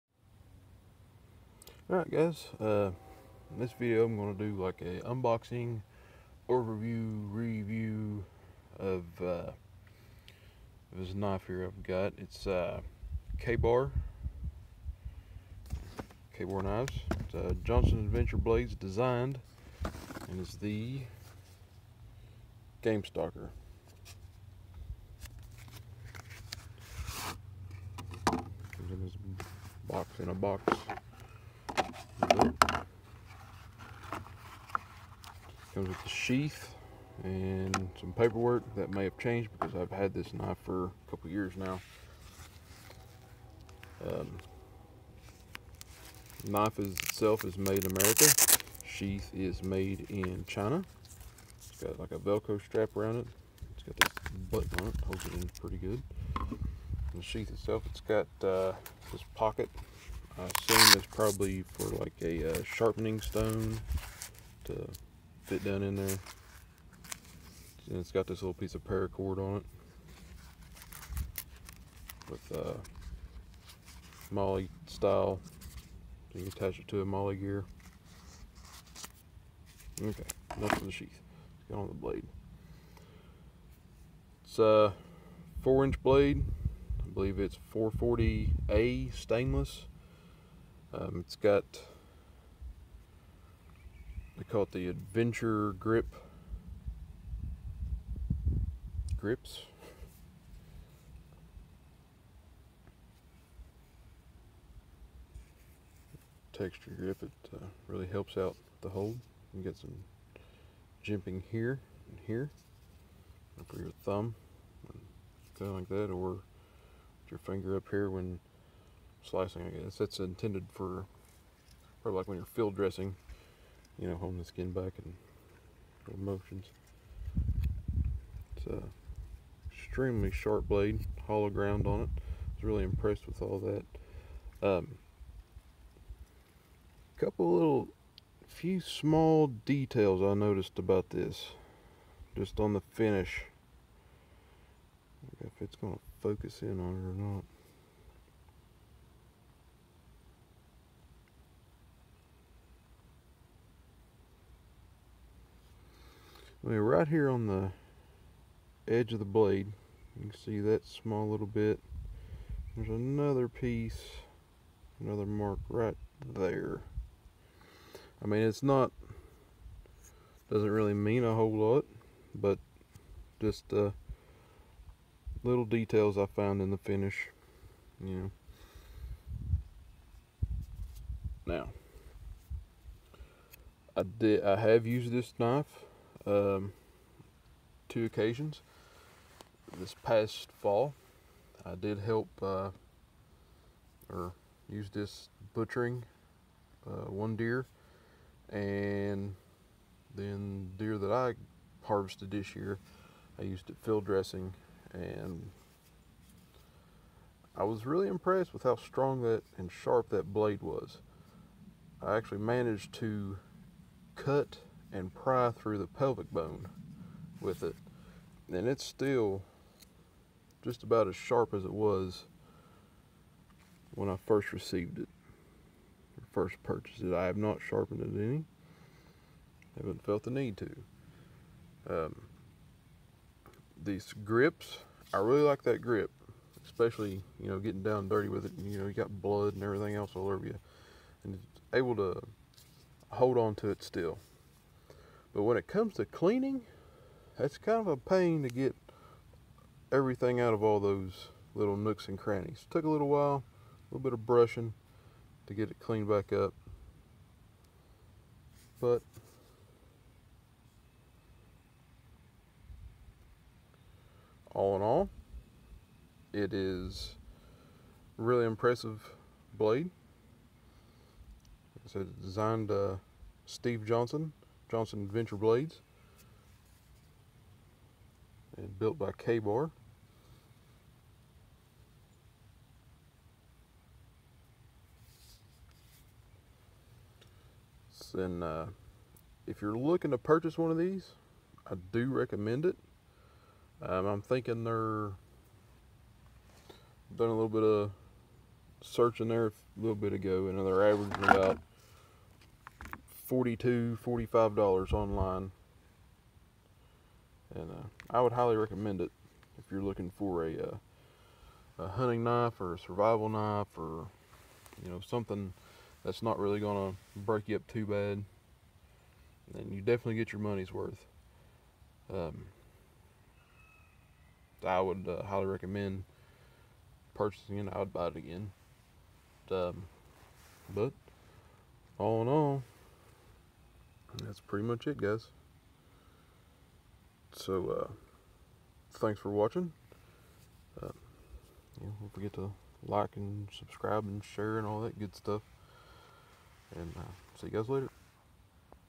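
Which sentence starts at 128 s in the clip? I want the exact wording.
It's a extremely sharp blade, hollow ground on it.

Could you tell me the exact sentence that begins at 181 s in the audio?
Now, I did, I have used this knife um, two occasions.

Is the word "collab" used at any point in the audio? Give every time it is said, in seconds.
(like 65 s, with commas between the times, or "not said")
not said.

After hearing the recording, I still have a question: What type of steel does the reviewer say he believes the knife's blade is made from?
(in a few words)
440A stainless.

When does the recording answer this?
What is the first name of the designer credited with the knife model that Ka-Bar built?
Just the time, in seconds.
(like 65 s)
273 s.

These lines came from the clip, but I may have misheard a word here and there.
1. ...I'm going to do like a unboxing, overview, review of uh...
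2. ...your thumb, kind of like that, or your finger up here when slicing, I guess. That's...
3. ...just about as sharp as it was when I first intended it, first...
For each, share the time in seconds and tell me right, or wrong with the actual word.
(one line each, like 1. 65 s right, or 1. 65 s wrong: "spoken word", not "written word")
1. 4 s right
2. 113 s right
3. 220 s wrong: "received", not "intended".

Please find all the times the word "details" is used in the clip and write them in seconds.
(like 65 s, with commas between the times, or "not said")
139 s, 175 s.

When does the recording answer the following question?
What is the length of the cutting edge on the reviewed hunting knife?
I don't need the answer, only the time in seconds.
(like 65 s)
85 s.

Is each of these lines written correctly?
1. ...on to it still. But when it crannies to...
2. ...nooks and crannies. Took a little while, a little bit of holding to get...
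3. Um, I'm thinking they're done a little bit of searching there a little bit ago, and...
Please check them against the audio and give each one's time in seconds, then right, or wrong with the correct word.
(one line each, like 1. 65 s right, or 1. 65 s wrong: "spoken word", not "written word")
1. 243 s wrong: "comes", not "crannies"
2. 251 s wrong: "brushing", not "holding"
3. 293 s right.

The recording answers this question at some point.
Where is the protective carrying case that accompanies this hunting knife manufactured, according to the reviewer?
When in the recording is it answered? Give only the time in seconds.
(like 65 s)
50 s.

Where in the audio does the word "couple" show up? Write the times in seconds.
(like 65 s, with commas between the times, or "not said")
41 s, 137 s.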